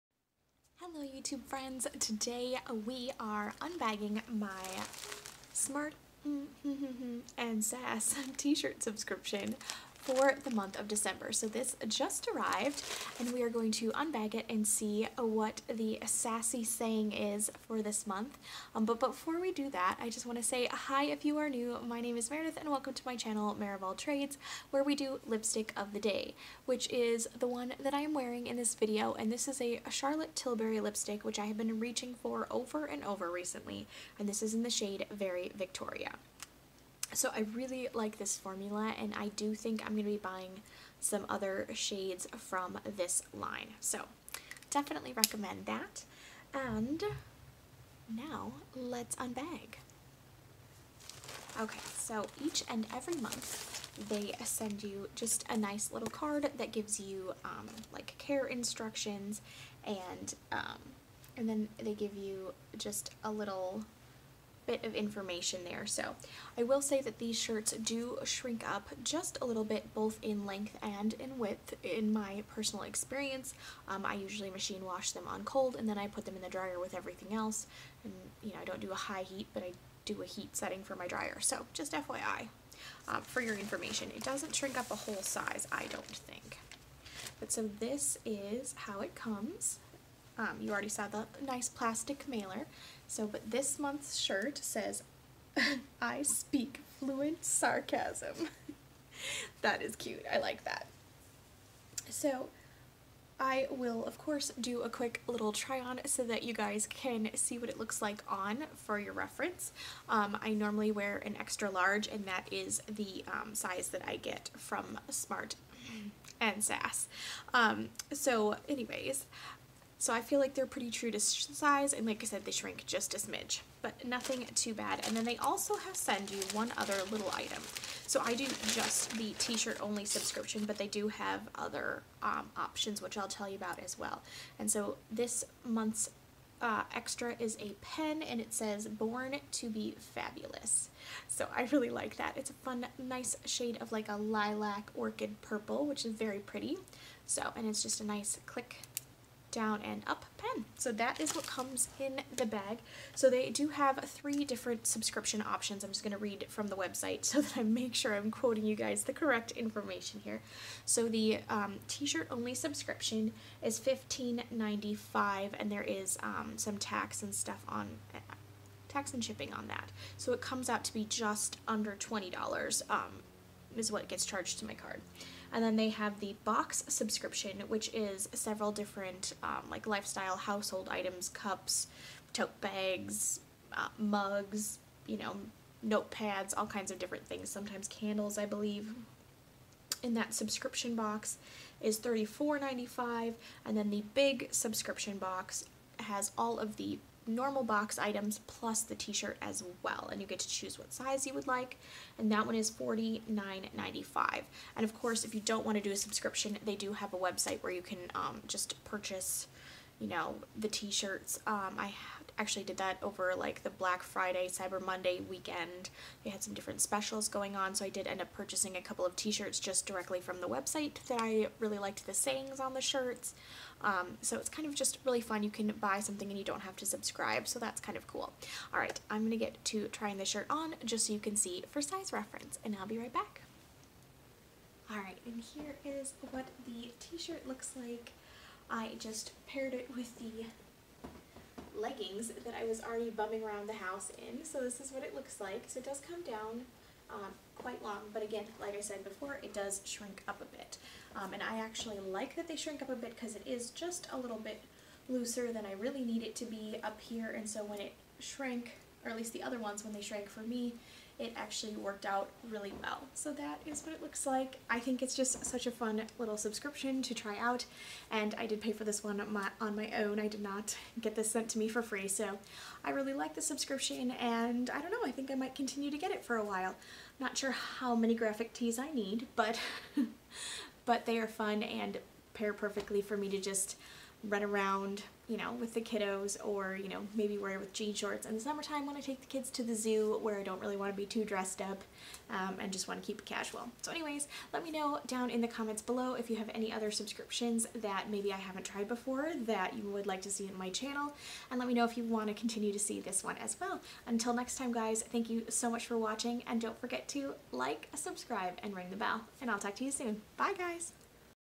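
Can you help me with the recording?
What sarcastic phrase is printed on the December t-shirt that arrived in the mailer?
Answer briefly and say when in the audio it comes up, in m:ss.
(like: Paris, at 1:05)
I speak fluent sarcasm, at 1:36.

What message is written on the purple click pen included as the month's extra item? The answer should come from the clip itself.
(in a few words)
Born to be fabulous.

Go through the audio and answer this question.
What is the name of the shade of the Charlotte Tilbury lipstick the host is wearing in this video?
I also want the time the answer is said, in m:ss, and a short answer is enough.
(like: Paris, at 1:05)
Very Victoria, at 0:35.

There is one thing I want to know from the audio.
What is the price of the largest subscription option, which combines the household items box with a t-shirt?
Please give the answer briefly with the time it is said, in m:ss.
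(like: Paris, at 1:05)
$49.95, at 3:22.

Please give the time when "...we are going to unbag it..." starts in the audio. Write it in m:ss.
0:13.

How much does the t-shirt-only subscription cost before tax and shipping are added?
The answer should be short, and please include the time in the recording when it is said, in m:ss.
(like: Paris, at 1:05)
$15.95, at 2:43.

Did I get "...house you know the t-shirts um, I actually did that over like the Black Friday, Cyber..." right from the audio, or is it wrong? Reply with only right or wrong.
wrong.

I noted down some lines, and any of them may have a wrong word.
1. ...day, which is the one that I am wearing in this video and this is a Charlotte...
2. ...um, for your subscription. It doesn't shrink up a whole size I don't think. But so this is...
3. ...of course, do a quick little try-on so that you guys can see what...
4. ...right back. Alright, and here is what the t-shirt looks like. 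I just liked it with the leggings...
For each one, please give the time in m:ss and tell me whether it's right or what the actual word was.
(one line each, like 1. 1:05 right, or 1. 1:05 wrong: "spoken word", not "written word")
1. 0:25 right
2. 1:23 wrong: "information", not "subscription"
3. 1:44 right
4. 3:52 wrong: "paired", not "liked".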